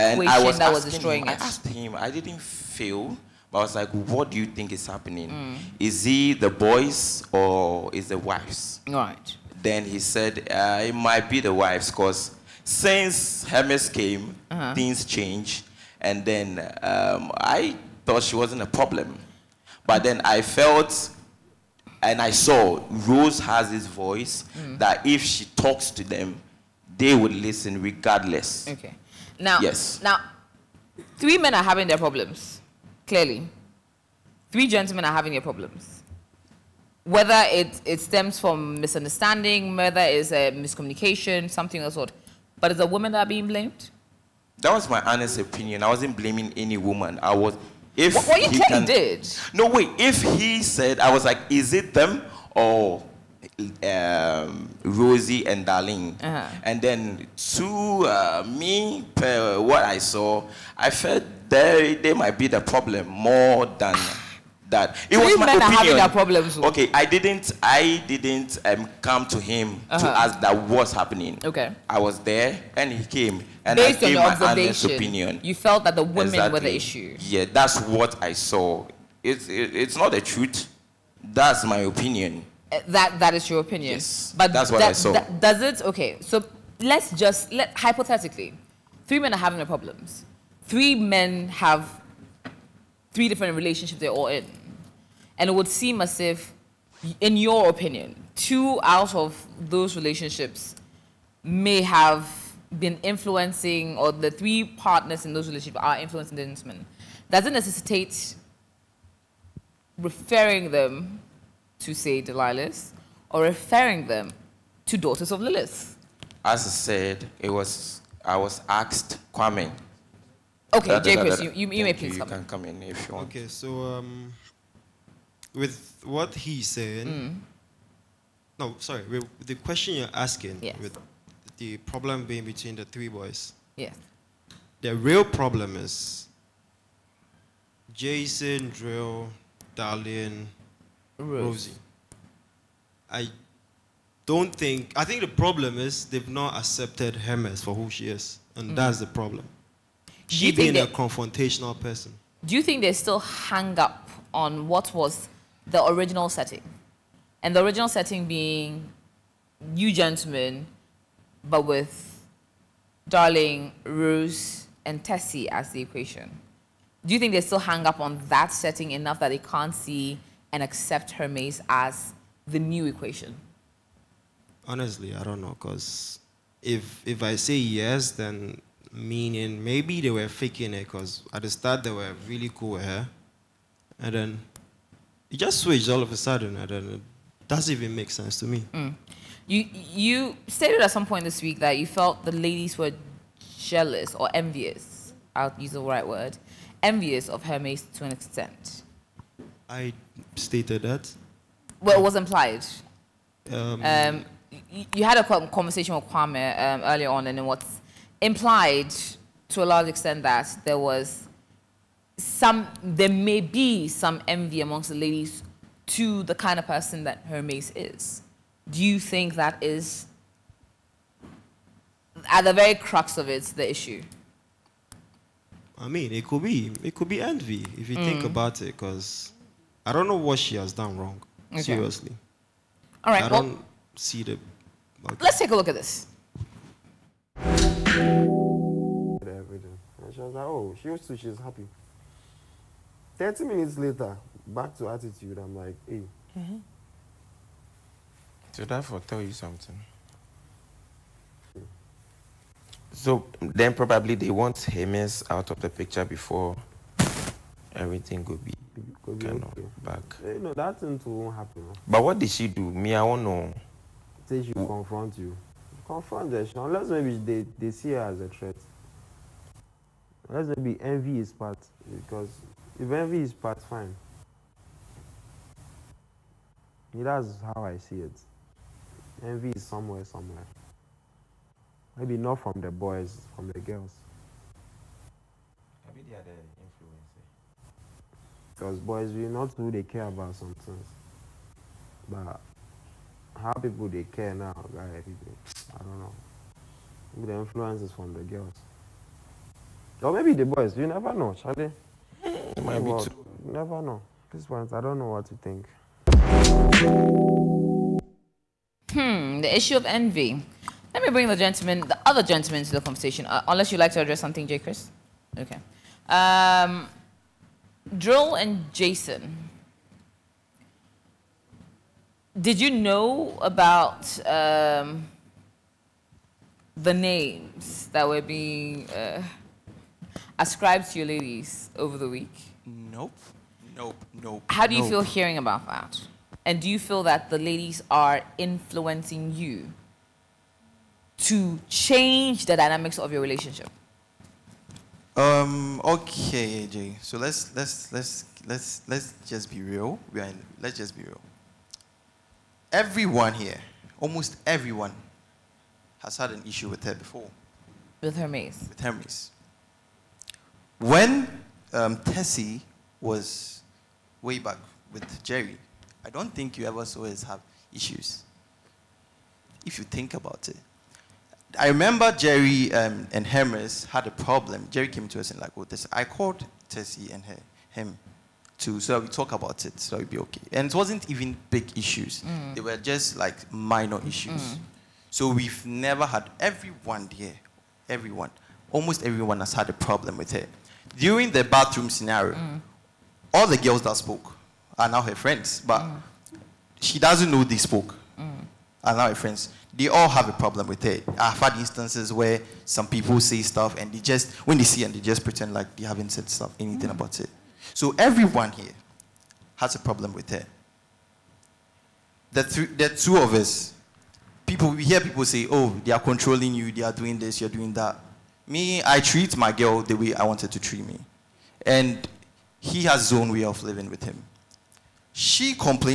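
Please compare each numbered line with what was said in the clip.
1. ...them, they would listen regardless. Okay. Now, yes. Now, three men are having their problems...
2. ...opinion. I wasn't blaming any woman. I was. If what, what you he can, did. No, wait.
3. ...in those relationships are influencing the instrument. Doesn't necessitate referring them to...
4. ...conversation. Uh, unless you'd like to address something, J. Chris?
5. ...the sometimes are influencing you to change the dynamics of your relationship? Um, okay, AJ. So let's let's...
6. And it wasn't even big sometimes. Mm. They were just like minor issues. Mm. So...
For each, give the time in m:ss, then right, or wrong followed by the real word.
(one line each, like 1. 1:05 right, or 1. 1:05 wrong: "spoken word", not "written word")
1. 0:26 right
2. 0:45 right
3. 1:45 right
4. 5:12 right
5. 5:37 wrong: "ladies", not "sometimes"
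6. 6:20 wrong: "issues", not "sometimes".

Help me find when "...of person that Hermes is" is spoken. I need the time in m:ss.
3:36.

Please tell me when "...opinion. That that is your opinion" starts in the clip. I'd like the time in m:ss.
1:21.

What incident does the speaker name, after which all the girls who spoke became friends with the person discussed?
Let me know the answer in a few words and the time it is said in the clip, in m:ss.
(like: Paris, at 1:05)
bathroom scenario, at 6:31.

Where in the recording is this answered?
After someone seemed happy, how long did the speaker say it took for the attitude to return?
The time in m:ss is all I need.
4:03.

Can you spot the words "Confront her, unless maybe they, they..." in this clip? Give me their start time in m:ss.
4:25.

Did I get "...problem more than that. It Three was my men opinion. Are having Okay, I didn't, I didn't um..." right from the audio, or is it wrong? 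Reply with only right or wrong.
right.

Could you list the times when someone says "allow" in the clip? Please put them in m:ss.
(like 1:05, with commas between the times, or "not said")
6:38.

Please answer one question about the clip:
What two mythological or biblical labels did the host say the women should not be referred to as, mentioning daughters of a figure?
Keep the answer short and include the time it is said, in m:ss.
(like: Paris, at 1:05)
Lilith, at 1:54.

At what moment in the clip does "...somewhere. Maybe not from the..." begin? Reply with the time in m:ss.
4:40.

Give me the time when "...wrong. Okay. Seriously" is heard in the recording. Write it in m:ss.
3:50.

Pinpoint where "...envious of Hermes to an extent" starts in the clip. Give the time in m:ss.
3:16.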